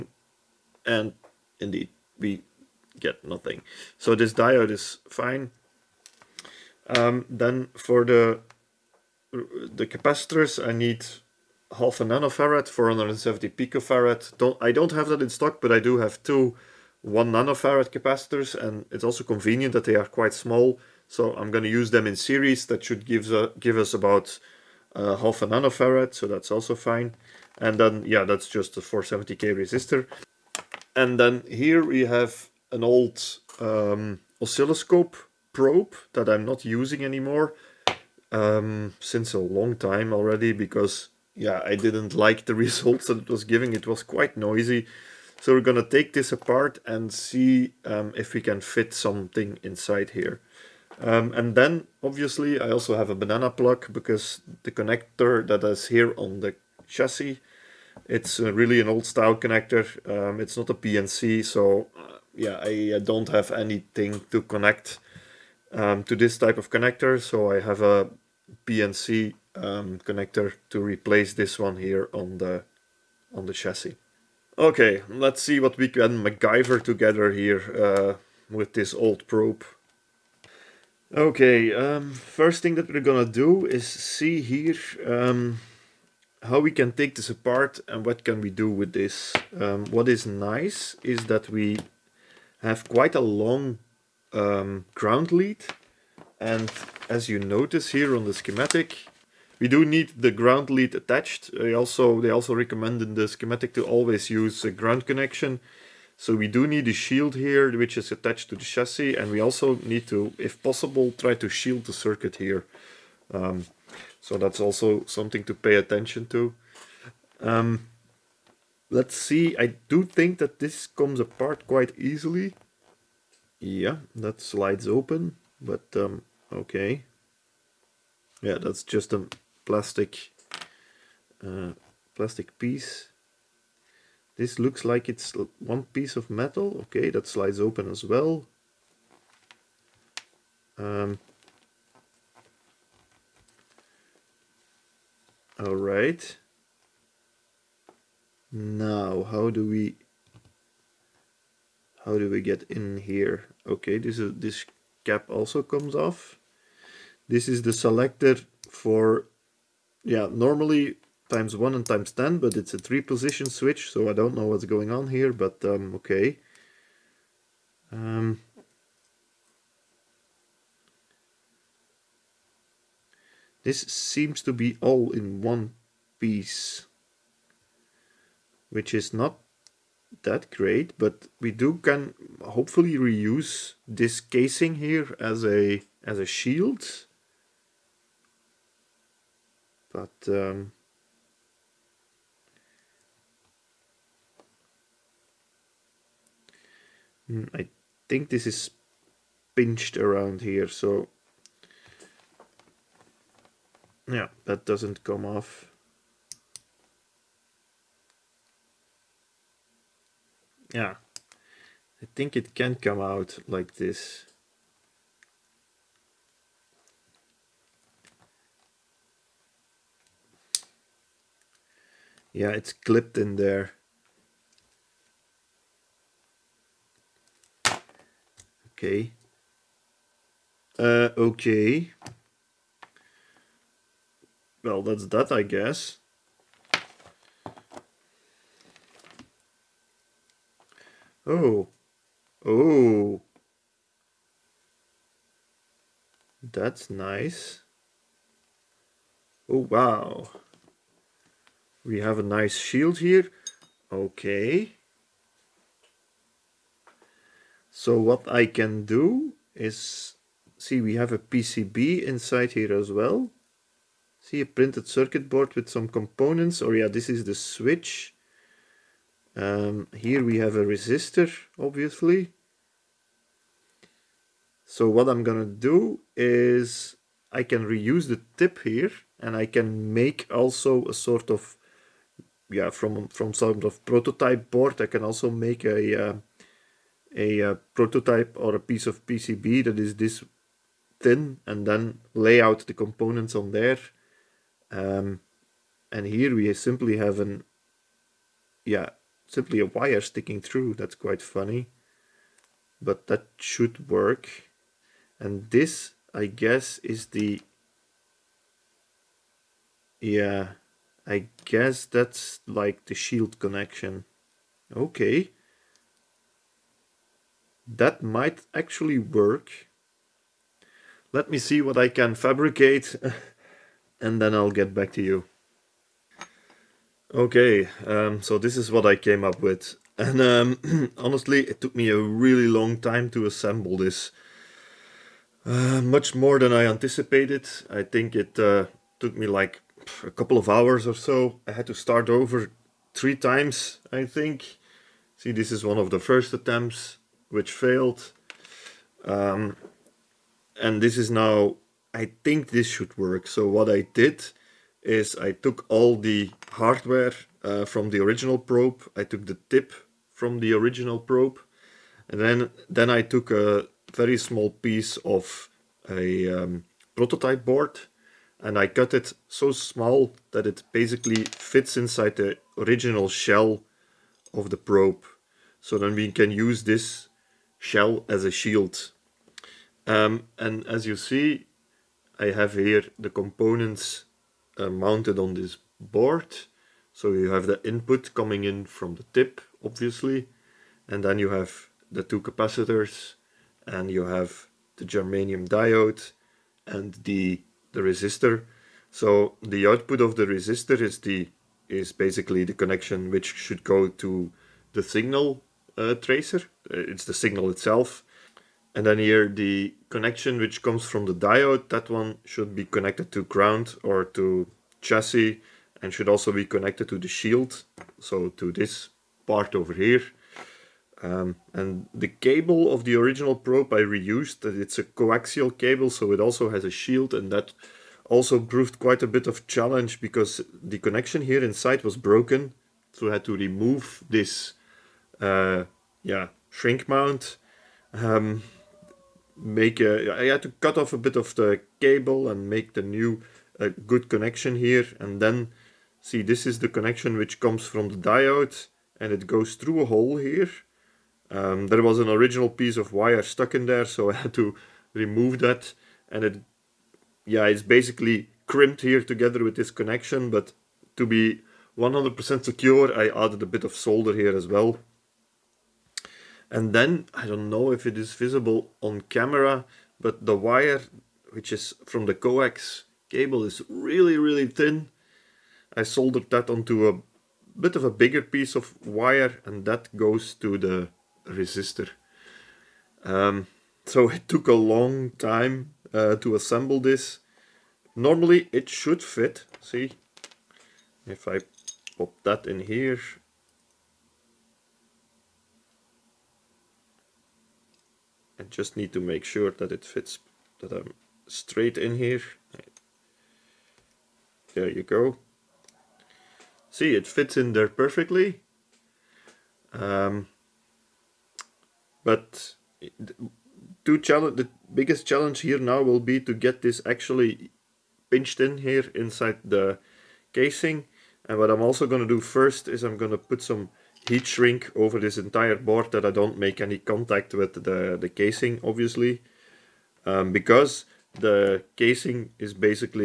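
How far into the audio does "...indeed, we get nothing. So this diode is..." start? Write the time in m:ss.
0:01.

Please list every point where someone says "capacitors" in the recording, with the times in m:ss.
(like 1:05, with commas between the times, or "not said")
0:09, 0:17, 6:32.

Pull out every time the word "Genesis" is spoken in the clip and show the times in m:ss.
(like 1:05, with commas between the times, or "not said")
not said.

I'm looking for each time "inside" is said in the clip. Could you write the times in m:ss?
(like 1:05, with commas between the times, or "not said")
0:49, 4:22, 6:11, 7:11, 8:38.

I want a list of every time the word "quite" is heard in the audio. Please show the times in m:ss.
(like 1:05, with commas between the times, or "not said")
0:20, 0:44, 1:32, 2:01, 5:00, 7:08.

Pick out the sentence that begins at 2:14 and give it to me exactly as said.
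This looks like it's one piece of metal.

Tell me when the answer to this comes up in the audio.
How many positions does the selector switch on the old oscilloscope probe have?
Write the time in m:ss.
2:42.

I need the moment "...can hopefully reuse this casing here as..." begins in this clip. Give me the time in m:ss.
3:01.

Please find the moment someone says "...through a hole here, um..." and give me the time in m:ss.
7:29.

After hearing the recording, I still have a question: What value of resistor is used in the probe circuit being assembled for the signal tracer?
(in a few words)
470k.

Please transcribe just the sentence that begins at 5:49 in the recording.
Um, and this is now, I think this should work.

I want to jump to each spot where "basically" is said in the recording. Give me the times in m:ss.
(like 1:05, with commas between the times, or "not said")
6:10, 6:41, 7:37, 8:52.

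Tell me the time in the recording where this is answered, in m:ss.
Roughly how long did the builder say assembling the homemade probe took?
5:40.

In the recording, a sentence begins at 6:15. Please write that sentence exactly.
So then we can use this shell as a shield.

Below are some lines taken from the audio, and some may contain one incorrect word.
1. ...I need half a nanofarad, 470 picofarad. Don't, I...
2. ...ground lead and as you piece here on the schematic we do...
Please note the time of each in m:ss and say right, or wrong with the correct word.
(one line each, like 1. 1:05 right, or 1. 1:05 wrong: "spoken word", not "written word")
1. 0:10 right
2. 1:34 wrong: "notice", not "piece".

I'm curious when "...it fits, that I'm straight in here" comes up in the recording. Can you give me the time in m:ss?
8:19.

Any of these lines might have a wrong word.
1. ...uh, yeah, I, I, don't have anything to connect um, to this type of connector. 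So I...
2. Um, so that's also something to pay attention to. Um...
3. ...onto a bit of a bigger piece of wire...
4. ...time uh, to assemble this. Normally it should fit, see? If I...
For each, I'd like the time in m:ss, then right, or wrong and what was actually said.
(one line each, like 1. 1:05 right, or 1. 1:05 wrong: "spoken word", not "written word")
1. 1:01 right
2. 1:53 right
3. 7:56 right
4. 8:05 right.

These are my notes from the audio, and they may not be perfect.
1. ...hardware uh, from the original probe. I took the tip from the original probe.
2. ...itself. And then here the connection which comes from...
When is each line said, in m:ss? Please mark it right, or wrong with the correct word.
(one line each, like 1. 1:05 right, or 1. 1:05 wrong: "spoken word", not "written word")
1. 5:56 right
2. 6:47 right.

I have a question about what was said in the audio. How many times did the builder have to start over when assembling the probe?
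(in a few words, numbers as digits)
3.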